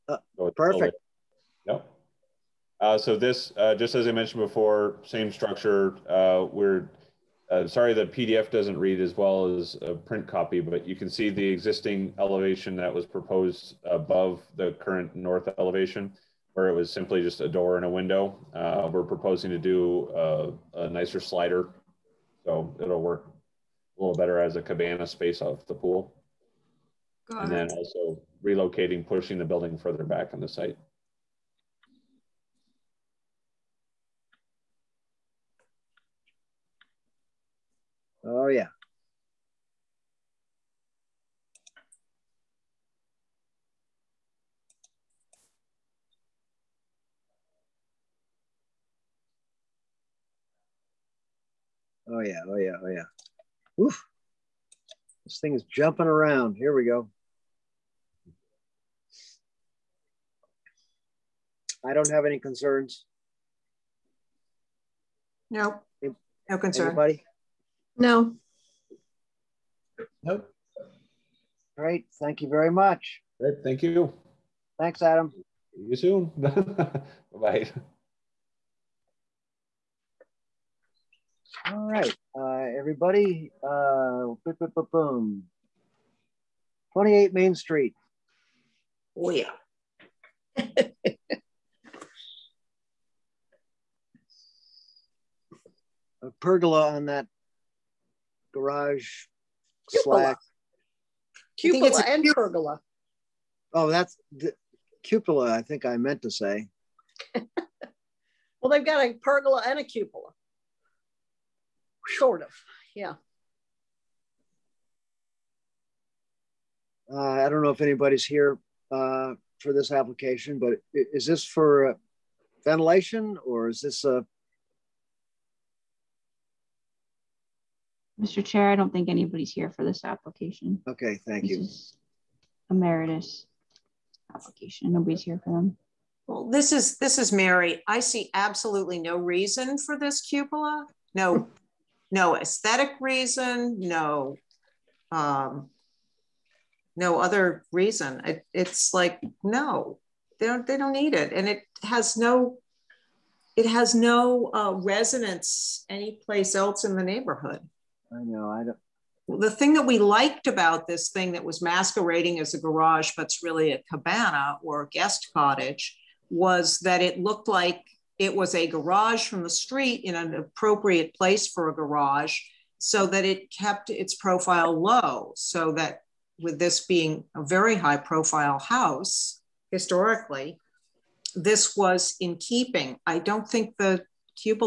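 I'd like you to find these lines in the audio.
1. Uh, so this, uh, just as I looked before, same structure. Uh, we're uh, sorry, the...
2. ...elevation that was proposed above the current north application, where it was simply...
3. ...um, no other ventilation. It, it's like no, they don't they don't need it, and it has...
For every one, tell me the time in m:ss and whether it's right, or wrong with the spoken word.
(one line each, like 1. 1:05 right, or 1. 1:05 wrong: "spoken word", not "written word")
1. 0:02 wrong: "mentioned", not "looked"
2. 0:12 wrong: "elevation", not "application"
3. 2:25 wrong: "reason", not "ventilation".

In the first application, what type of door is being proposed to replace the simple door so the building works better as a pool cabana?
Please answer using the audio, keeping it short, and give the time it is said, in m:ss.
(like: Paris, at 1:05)
Slider, at 0:21.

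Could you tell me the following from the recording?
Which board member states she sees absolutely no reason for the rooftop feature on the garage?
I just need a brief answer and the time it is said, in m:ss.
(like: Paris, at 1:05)
Mary, at 2:17.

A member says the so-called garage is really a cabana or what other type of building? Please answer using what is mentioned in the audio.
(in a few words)
Guest cottage.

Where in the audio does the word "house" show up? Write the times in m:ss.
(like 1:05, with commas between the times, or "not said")
2:58.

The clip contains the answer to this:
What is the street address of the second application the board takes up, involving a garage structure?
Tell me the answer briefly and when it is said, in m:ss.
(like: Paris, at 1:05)
28 Main Street, at 1:26.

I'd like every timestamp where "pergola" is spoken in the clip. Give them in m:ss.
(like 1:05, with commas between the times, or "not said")
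1:36, 1:42, 1:49.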